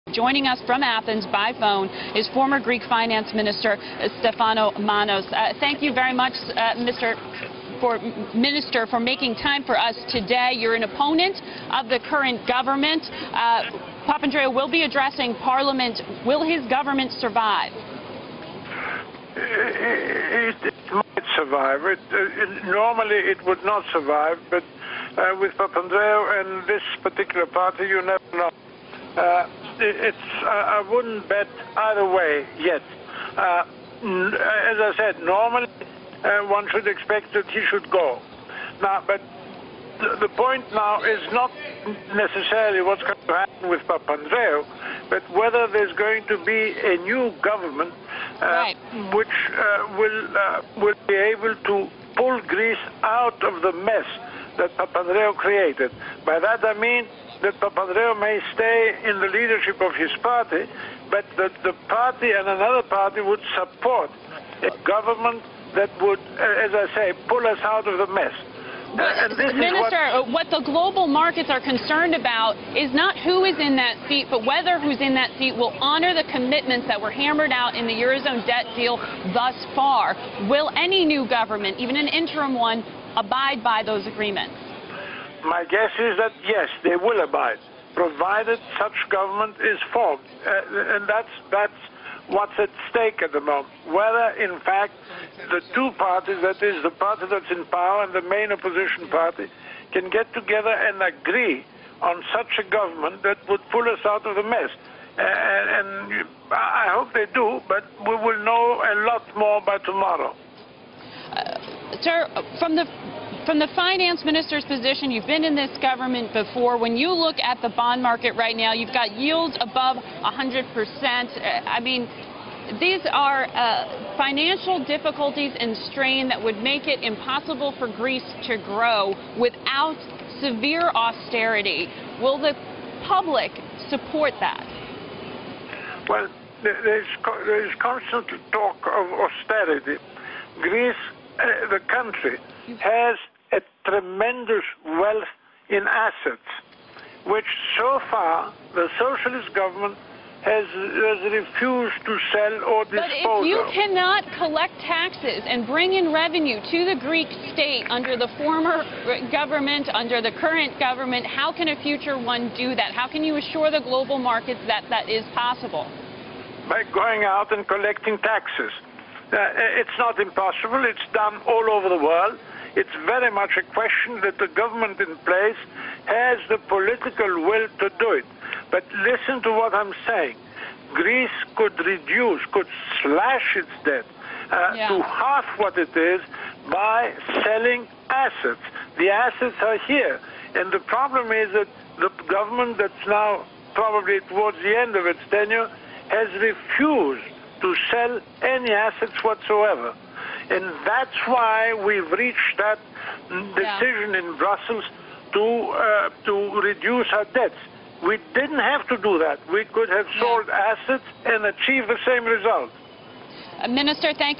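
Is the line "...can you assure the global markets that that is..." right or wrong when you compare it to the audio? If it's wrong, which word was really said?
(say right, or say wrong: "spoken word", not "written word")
right.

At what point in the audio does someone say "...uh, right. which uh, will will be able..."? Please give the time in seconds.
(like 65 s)
48 s.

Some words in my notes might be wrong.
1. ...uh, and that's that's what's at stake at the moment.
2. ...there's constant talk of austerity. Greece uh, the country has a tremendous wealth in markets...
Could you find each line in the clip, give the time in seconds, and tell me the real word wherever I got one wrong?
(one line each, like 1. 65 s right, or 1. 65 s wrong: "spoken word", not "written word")
1. 90 s right
2. 137 s wrong: "assets", not "markets".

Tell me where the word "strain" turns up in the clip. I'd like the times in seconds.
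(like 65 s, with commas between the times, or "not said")
125 s.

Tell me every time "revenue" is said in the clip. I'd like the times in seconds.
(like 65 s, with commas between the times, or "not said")
156 s.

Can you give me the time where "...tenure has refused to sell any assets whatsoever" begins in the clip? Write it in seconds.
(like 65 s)
195 s.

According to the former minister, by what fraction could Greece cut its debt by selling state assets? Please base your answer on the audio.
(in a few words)
half.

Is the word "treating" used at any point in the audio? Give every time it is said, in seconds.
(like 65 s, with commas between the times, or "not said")
not said.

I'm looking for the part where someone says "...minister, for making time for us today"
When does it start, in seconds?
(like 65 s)
8 s.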